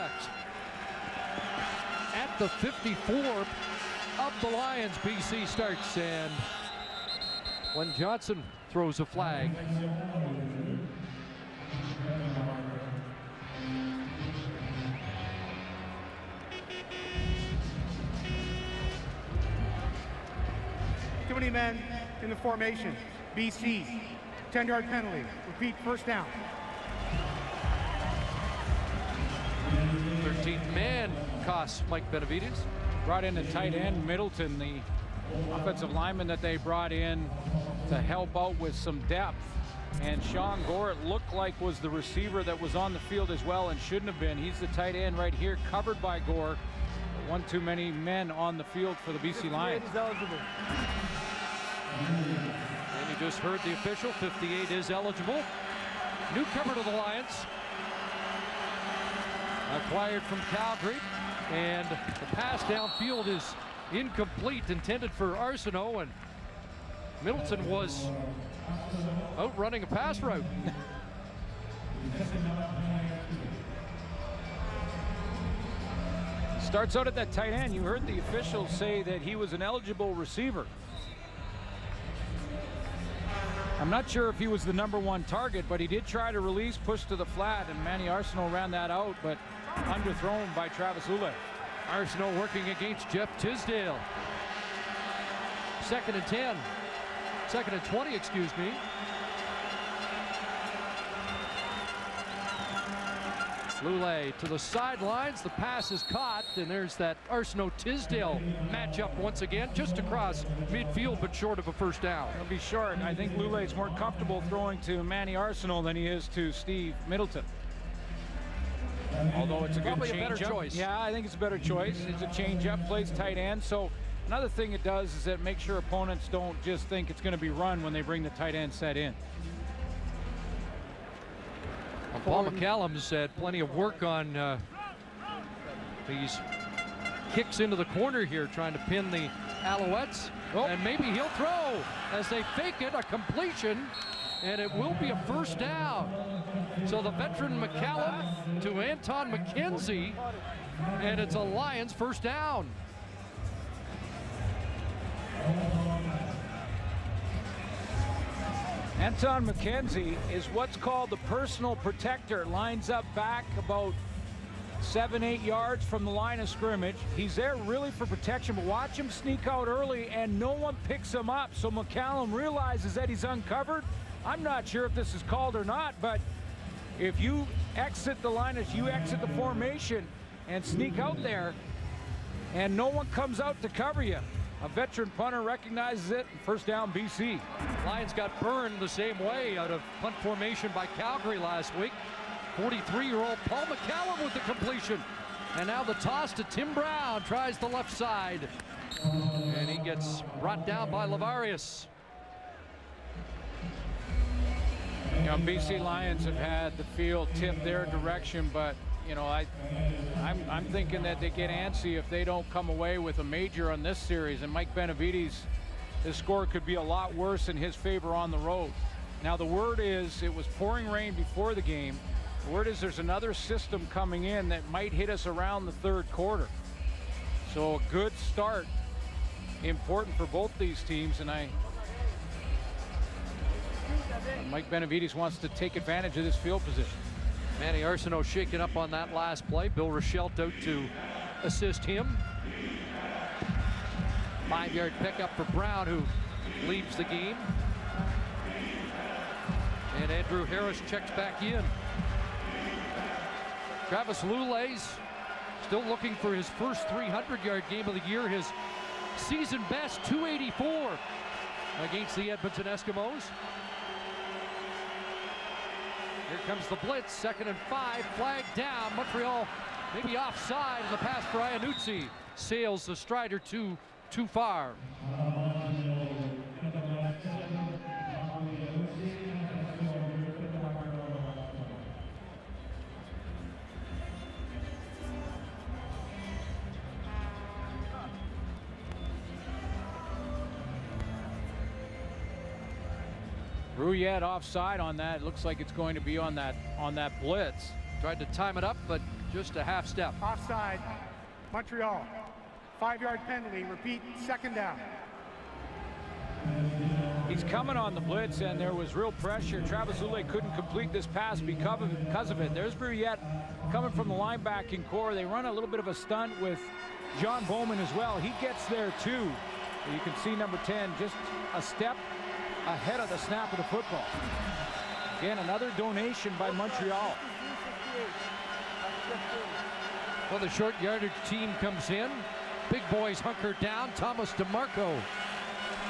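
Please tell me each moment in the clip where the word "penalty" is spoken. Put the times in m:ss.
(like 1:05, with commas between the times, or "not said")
0:24, 5:03.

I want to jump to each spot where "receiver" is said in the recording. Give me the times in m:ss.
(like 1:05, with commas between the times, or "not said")
0:41, 1:20.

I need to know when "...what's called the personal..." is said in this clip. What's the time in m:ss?
2:40.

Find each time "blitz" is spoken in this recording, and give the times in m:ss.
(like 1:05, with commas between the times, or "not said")
4:26, 4:57, 5:07.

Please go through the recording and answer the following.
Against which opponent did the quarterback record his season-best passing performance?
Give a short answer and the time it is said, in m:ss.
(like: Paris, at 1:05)
Edmonton Eskimos, at 4:22.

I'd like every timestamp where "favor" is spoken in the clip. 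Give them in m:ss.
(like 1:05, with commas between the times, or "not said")
3:37.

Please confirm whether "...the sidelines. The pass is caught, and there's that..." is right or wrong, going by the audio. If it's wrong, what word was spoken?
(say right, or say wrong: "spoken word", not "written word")
right.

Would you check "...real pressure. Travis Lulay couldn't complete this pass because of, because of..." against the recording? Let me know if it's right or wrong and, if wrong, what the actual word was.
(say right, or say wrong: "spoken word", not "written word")
right.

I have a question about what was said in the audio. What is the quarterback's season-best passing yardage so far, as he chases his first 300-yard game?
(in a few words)
284.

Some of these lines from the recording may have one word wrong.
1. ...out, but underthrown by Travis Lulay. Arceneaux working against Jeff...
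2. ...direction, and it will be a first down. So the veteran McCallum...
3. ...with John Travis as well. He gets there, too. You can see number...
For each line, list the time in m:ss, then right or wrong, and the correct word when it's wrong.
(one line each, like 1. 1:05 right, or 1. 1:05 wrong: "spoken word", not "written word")
1. 1:28 right
2. 2:23 wrong: "completion", not "direction"
3. 5:16 wrong: "Bowman", not "Travis".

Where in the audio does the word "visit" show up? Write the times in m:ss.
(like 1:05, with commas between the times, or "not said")
not said.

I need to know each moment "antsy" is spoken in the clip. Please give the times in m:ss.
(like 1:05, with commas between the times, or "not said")
3:31.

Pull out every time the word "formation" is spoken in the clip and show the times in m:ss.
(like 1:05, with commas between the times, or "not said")
0:22, 2:59, 3:10.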